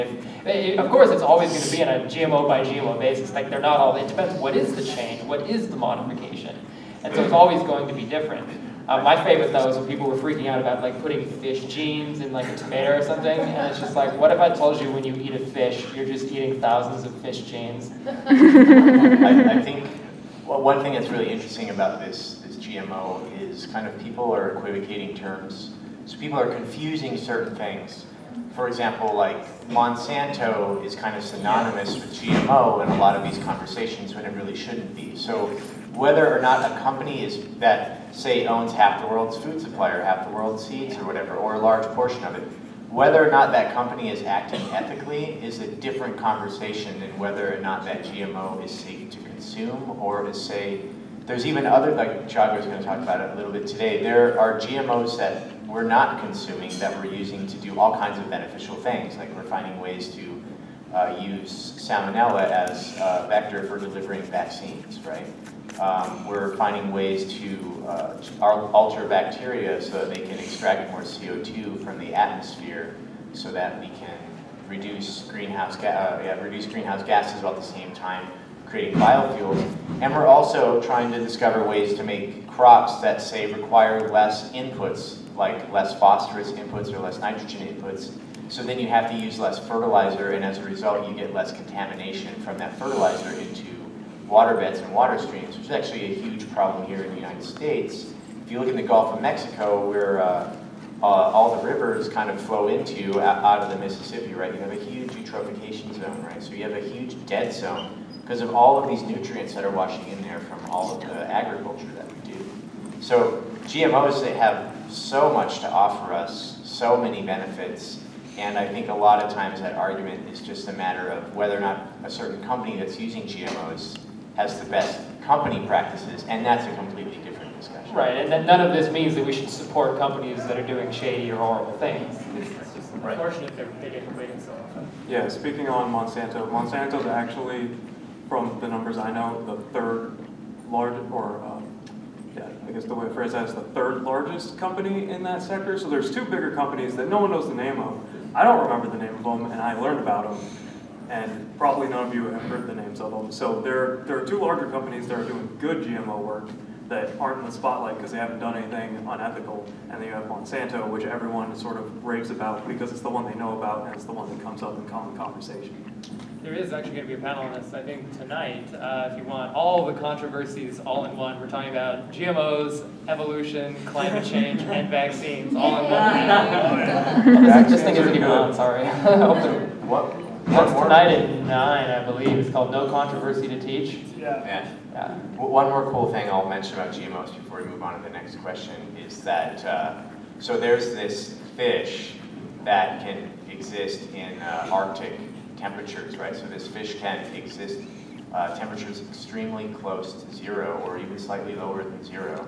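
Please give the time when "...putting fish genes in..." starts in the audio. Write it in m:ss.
0:11.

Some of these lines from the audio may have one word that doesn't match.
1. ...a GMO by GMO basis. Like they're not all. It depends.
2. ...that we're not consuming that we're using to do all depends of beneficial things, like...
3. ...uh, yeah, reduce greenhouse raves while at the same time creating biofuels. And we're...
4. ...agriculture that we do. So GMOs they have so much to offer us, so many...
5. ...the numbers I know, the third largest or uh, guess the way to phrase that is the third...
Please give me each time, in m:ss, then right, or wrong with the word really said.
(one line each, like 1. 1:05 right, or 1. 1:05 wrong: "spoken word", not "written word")
1. 0:01 right
2. 0:55 wrong: "kinds", not "depends"
3. 1:15 wrong: "gases", not "raves"
4. 1:51 right
5. 2:18 right.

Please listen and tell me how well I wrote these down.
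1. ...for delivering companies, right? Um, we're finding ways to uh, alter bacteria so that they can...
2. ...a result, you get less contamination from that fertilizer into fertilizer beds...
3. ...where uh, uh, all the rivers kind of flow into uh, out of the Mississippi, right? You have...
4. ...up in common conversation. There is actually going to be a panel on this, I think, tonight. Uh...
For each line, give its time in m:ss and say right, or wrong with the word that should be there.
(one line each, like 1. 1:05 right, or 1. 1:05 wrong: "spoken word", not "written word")
1. 1:03 wrong: "vaccines", not "companies"
2. 1:30 wrong: "water", not "fertilizer"
3. 1:39 right
4. 2:44 right.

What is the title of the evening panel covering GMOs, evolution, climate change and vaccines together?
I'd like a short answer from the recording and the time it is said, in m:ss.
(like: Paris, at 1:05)
No Controversy to Teach, at 3:02.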